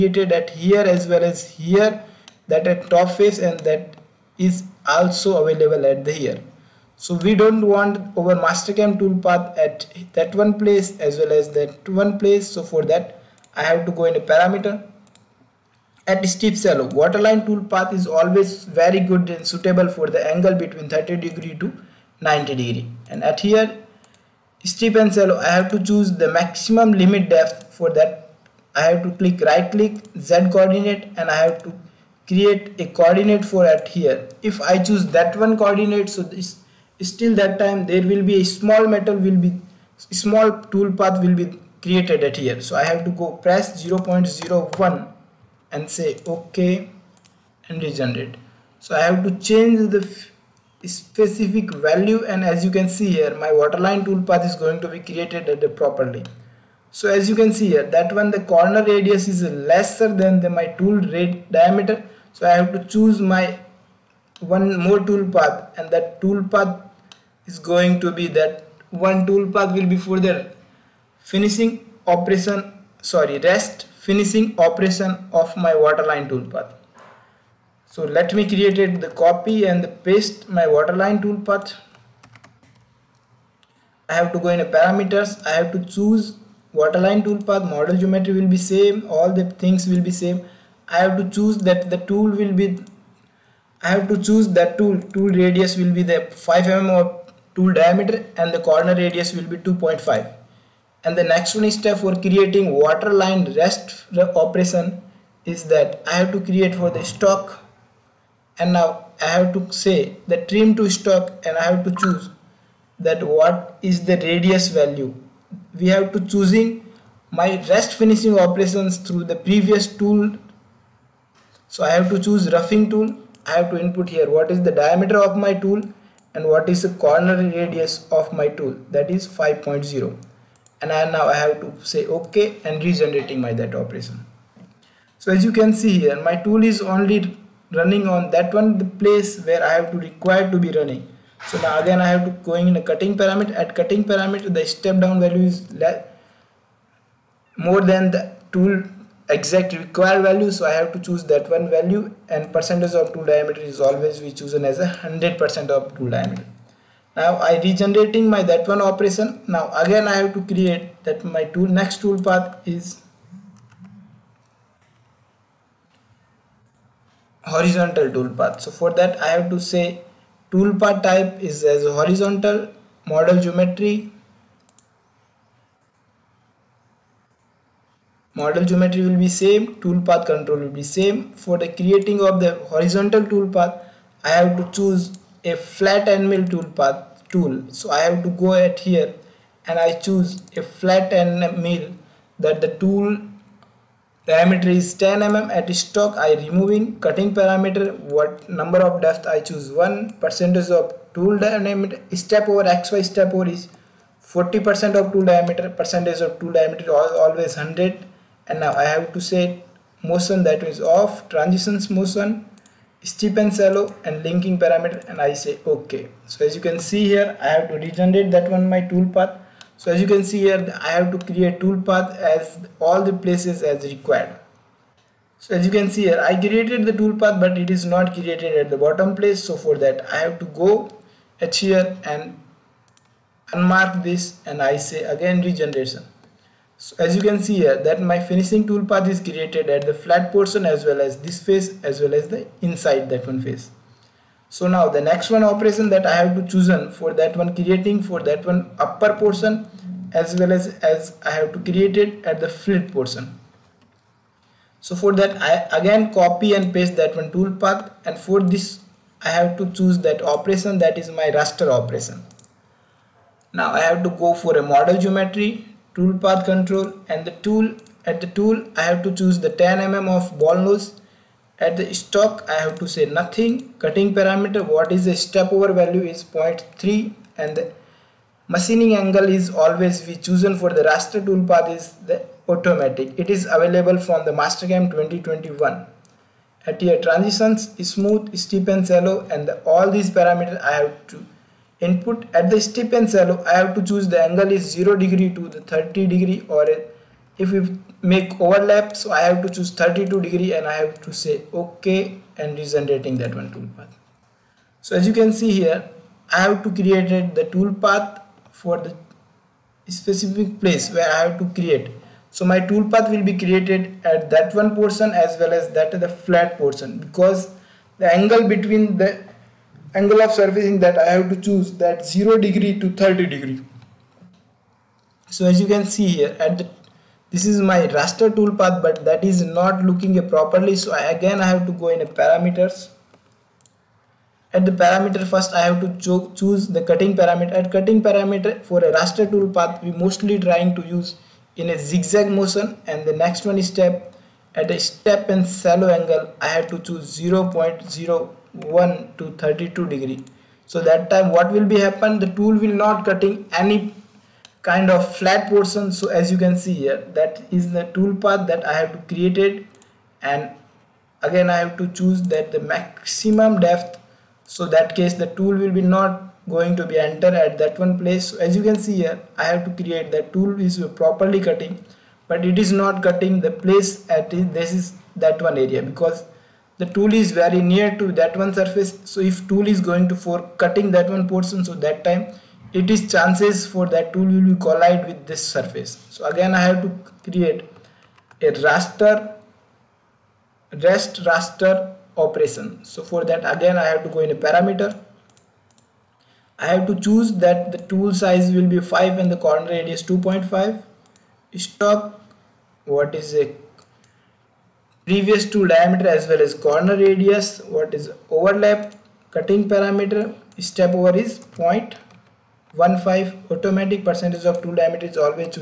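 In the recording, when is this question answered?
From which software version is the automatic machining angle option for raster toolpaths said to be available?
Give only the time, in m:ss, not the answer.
4:44.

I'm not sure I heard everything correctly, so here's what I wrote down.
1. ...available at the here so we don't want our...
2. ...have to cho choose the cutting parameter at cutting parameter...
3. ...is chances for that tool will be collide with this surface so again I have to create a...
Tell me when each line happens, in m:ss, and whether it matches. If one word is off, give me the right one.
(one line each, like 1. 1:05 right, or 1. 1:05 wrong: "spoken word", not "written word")
1. 0:05 right
2. 5:35 right
3. 6:22 right.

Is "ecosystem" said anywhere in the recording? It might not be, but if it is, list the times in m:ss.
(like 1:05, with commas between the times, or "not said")
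not said.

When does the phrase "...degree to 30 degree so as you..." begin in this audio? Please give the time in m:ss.
5:22.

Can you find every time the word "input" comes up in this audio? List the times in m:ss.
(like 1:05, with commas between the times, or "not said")
2:03, 4:51.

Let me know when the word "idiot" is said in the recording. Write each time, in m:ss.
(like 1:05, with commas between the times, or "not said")
not said.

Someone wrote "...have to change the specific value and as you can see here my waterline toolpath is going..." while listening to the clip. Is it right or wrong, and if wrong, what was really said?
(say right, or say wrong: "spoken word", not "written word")
right.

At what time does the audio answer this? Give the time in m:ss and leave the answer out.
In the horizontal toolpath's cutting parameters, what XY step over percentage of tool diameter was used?
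3:24.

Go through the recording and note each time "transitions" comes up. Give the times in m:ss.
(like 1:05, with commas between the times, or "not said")
3:31, 4:47.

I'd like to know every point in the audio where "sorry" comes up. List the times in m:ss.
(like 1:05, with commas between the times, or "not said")
1:13.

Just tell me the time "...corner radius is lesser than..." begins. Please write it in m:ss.
0:58.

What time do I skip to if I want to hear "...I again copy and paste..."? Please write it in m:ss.
4:15.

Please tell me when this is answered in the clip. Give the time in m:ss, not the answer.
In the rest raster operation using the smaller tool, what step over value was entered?
6:51.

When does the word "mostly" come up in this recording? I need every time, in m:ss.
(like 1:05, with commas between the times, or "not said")
5:39.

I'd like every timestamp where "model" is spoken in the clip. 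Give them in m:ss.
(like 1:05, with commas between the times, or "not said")
1:27, 2:53, 2:58, 4:24.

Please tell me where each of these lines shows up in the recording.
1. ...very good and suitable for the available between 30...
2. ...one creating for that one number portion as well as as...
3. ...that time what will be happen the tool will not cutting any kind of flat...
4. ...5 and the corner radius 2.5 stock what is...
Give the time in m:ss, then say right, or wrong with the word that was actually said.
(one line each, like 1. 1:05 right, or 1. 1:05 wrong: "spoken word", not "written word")
1. 0:18 wrong: "angle", not "available"
2. 4:07 wrong: "upper", not "number"
3. 5:50 right
4. 6:38 right.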